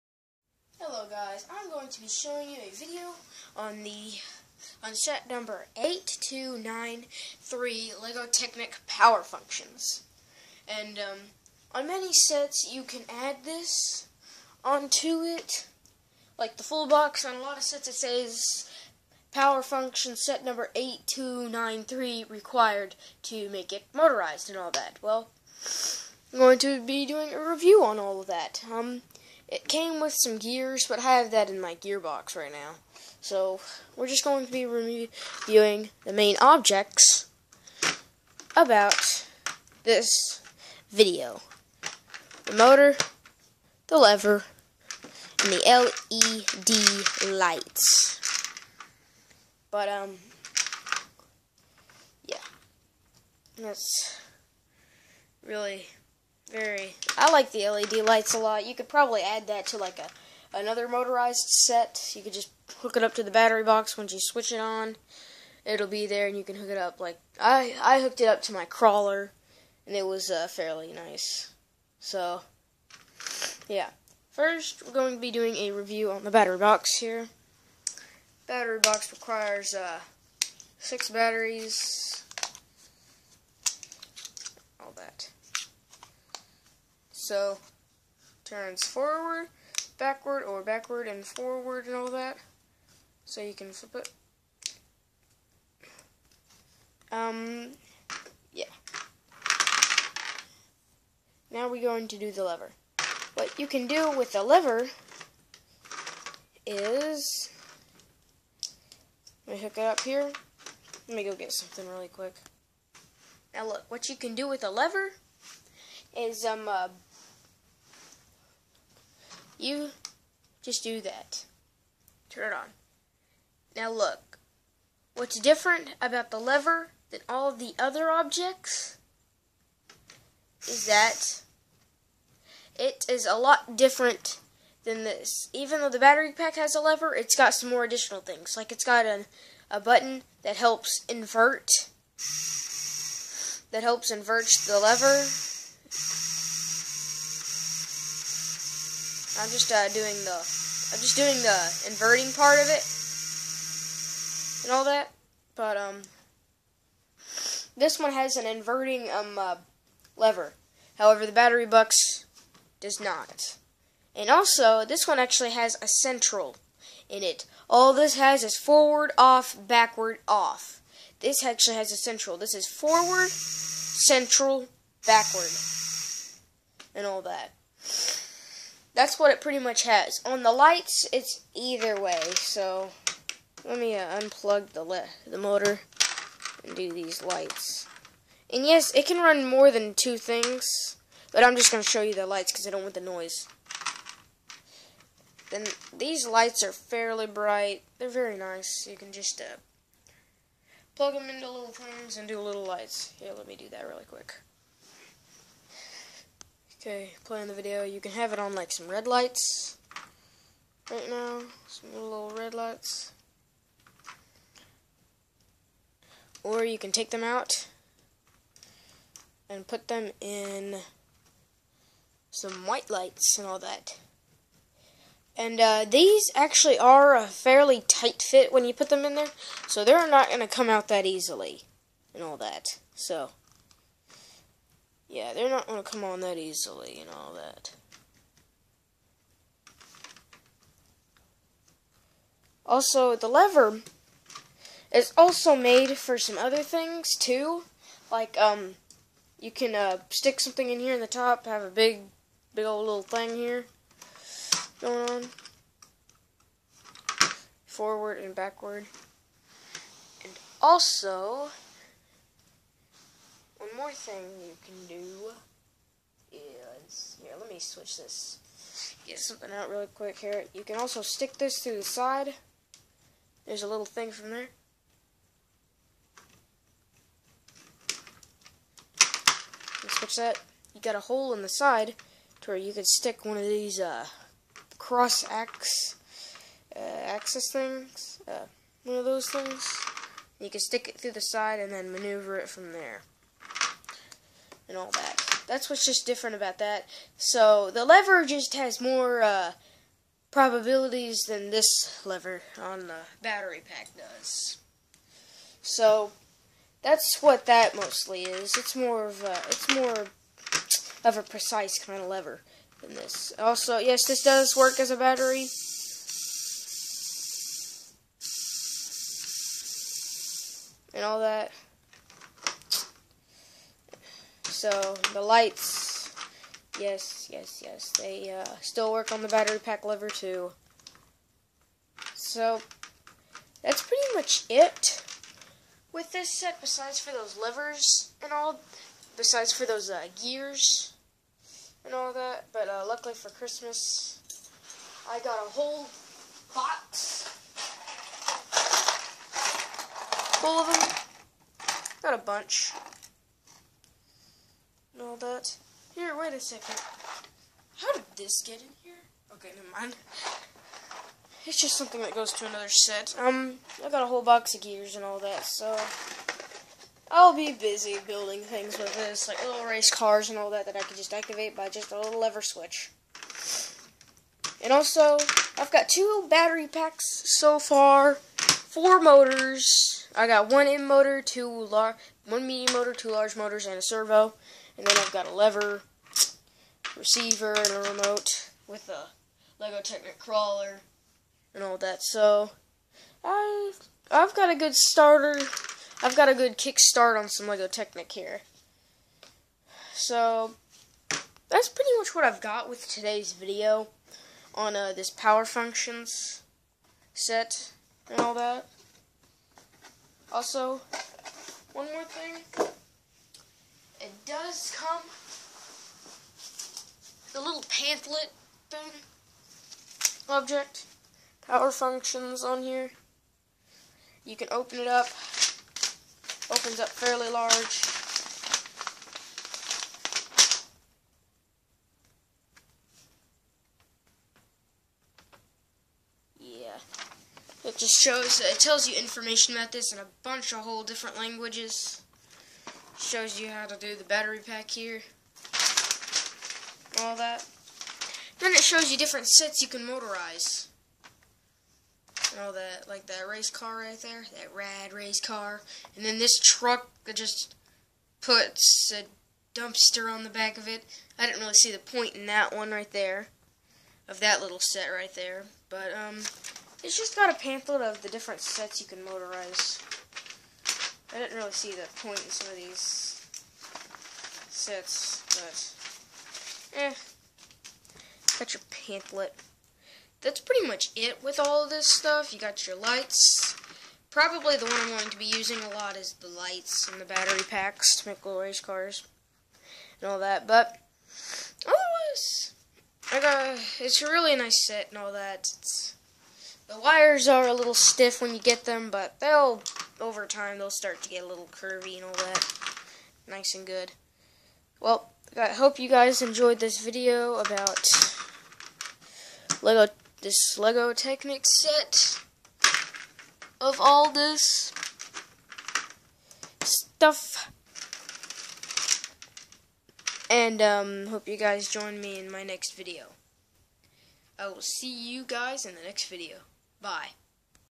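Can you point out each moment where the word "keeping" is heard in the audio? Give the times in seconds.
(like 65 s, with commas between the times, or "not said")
not said.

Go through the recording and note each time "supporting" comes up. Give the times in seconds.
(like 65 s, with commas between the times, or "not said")
not said.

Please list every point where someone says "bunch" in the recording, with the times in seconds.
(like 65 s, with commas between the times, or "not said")
352 s, 440 s.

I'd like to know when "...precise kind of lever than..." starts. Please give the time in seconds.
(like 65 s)
311 s.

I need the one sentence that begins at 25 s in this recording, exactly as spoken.
Well, I'm going to be doing a review on all of that.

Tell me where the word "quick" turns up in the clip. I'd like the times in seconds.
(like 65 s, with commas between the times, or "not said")
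112 s, 204 s, 269 s.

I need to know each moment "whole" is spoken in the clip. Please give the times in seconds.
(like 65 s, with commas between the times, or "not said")
345 s, 364 s, 440 s.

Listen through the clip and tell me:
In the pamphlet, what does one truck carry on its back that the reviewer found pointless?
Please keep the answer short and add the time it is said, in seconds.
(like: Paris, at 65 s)
a dumpster, at 459 s.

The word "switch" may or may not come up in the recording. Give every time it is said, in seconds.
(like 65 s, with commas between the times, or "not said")
64 s, 267 s, 279 s, 372 s.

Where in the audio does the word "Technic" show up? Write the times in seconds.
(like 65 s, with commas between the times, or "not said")
8 s, 389 s, 397 s, 510 s.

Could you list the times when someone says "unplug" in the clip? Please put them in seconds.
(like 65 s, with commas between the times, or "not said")
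184 s.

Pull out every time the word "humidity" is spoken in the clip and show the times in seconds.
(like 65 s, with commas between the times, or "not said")
not said.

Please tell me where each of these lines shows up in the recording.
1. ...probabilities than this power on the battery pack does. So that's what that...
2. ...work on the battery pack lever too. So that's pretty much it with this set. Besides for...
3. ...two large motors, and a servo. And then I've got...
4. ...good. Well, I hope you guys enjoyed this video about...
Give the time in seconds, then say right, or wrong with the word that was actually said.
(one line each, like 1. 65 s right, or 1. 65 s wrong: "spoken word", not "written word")
1. 300 s wrong: "lever", not "power"
2. 328 s right
3. 382 s right
4. 503 s right.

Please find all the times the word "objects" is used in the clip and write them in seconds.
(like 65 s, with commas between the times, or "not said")
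36 s, 128 s, 420 s.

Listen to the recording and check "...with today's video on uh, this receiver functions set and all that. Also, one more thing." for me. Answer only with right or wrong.
wrong.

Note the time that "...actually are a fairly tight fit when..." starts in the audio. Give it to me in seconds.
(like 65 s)
226 s.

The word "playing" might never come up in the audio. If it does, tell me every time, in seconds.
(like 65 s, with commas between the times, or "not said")
207 s.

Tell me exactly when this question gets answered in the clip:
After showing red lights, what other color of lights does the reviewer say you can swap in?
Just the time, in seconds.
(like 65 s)
222 s.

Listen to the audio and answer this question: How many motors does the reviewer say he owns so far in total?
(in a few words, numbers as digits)
4.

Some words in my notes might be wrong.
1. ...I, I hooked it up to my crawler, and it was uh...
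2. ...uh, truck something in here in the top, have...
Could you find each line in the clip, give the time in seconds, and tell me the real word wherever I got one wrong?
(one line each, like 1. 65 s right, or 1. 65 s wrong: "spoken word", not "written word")
1. 67 s right
2. 249 s wrong: "stick", not "truck".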